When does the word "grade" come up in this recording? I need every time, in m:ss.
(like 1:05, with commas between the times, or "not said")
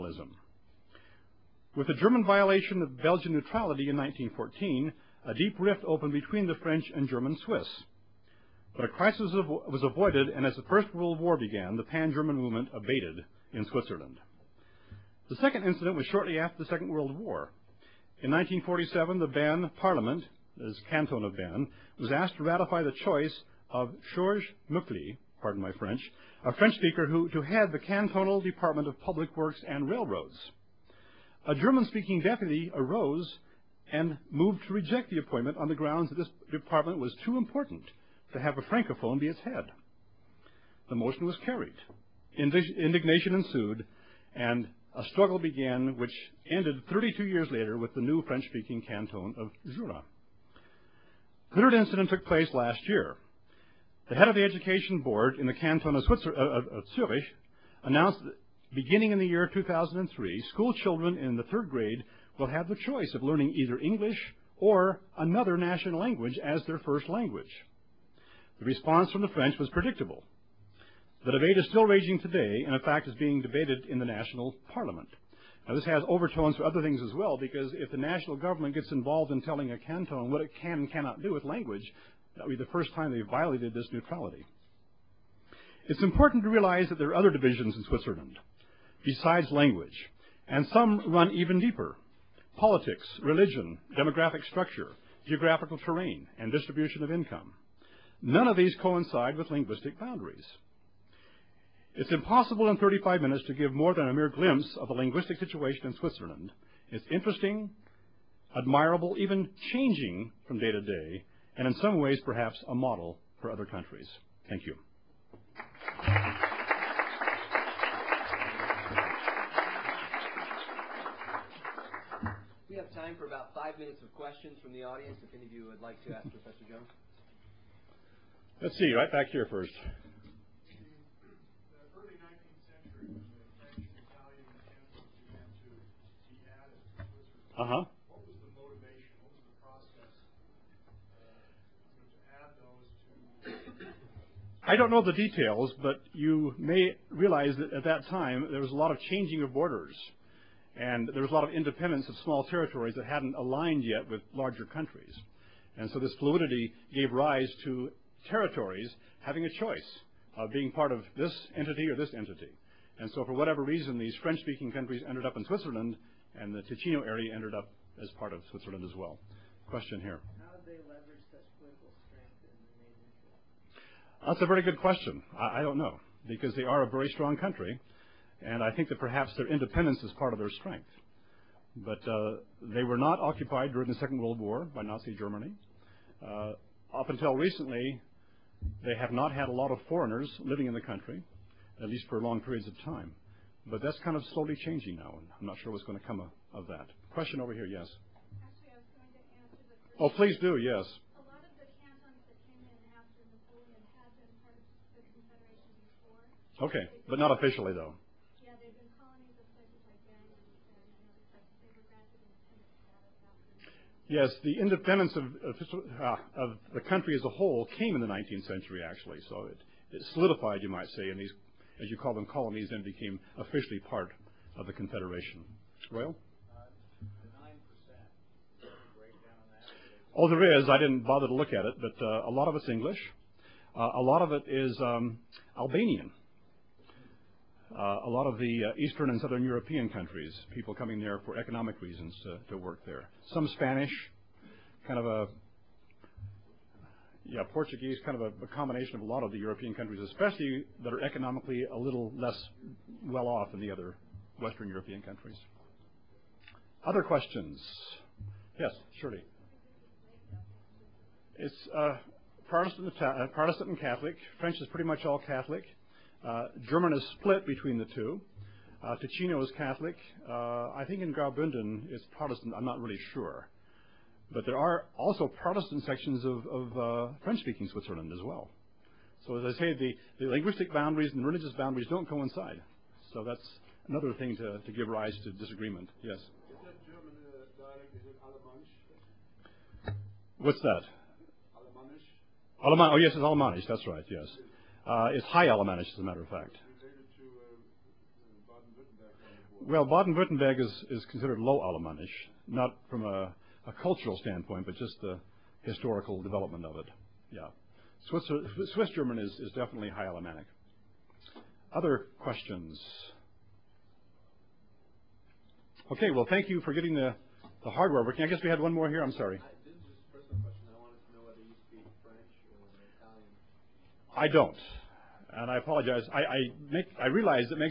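1:01.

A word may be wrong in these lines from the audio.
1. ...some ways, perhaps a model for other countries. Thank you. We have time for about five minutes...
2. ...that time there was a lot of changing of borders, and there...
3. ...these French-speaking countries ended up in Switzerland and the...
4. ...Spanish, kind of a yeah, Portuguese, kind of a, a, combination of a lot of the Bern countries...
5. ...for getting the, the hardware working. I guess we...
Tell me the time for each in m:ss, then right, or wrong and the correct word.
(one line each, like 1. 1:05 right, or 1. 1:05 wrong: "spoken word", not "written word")
1. 1:51 right
2. 2:27 right
3. 2:43 right
4. 4:03 wrong: "European", not "Bern"
5. 5:16 right.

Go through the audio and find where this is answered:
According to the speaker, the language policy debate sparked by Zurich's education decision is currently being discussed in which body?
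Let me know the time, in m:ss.
1:14.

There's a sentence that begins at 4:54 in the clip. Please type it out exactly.
Uh, it's High Alemannic, as a matter of fact.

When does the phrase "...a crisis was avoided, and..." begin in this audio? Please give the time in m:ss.
0:08.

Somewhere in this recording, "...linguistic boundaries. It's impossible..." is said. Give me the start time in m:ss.
1:39.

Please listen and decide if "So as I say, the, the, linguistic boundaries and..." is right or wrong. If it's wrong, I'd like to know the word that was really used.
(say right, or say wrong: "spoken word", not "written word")
right.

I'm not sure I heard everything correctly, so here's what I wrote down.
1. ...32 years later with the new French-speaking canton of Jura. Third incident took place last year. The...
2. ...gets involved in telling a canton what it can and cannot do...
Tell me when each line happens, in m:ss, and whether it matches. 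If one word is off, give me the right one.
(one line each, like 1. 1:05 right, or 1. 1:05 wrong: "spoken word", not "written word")
1. 0:46 right
2. 1:18 right.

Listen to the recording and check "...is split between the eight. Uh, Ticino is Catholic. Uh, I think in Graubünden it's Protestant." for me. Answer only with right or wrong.
wrong.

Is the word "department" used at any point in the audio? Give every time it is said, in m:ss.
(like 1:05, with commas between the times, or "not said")
0:28, 0:36.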